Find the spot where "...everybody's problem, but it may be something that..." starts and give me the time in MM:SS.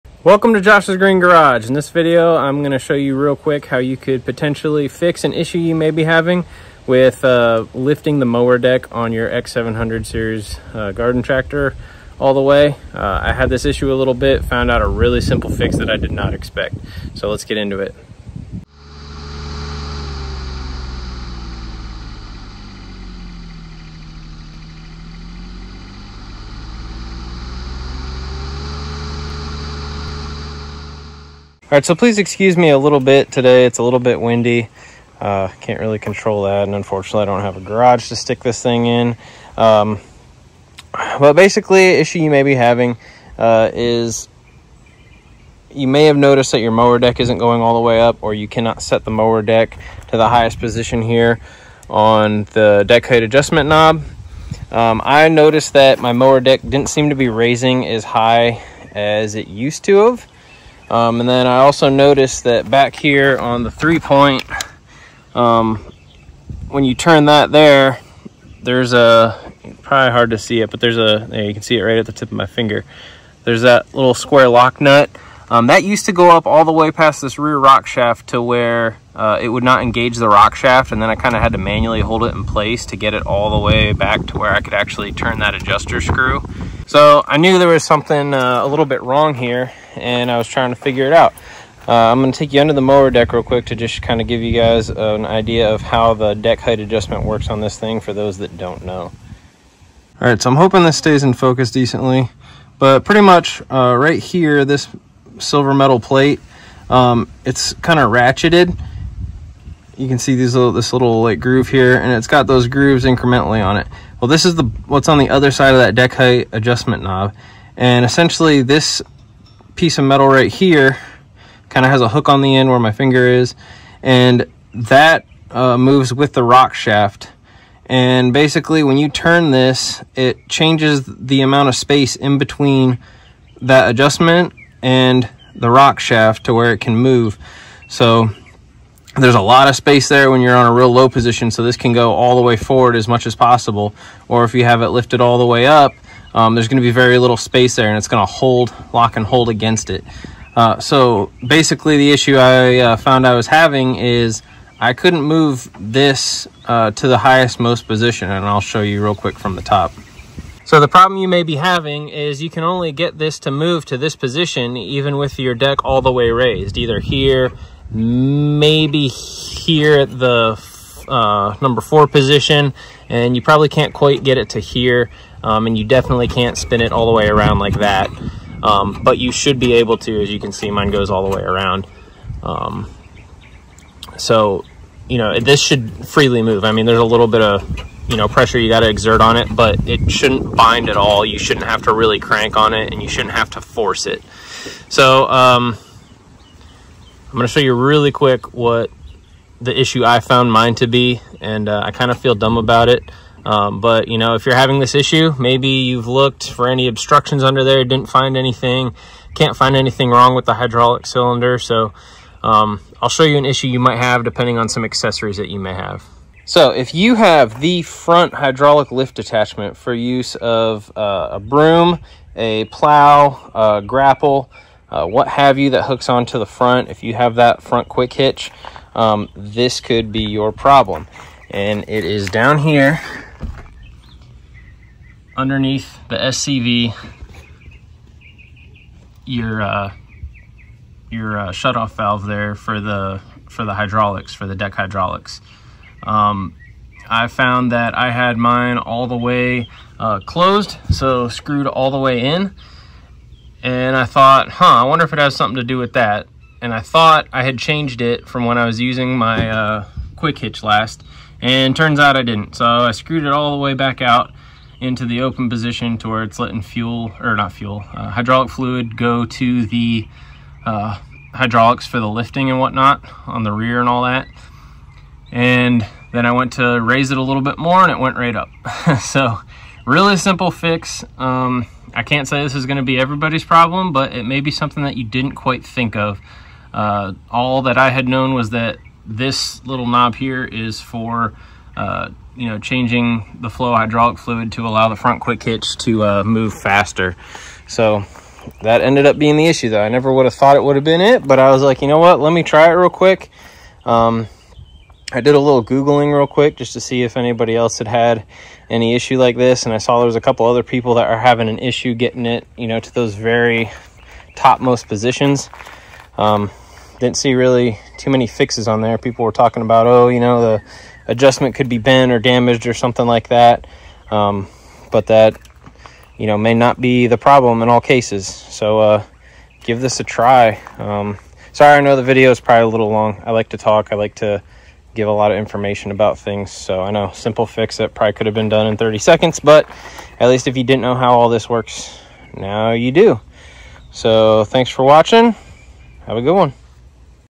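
04:42.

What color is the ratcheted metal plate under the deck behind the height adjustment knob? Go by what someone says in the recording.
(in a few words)
silver.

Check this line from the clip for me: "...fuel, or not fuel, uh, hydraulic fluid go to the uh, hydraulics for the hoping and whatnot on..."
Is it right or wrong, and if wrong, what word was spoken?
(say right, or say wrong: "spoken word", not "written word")
wrong: "lifting", not "hoping".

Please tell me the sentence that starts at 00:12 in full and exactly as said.
Uh, I had this issue a little bit, found out a really simple fix that I did not expect.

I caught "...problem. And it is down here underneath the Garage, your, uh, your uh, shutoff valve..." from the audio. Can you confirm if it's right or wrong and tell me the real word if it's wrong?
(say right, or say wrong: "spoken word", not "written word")
wrong: "SCV", not "Garage".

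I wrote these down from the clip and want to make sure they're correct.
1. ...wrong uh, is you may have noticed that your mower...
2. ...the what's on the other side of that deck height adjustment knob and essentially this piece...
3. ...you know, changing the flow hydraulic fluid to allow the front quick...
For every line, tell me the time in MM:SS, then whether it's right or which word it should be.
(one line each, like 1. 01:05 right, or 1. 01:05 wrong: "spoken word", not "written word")
1. 00:42 wrong: "having", not "wrong"
2. 01:54 right
3. 04:52 right.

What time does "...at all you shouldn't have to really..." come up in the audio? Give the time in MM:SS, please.
03:10.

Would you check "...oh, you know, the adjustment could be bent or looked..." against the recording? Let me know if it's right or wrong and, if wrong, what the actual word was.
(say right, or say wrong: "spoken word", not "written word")
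wrong: "damaged", not "looked".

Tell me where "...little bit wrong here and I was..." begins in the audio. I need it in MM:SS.
01:28.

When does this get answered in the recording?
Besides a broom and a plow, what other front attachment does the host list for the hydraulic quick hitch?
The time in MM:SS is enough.
03:43.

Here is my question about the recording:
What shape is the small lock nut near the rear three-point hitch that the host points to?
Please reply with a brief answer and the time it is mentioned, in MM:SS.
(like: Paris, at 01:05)
square, at 01:14.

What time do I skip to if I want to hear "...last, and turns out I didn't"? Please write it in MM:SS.
04:20.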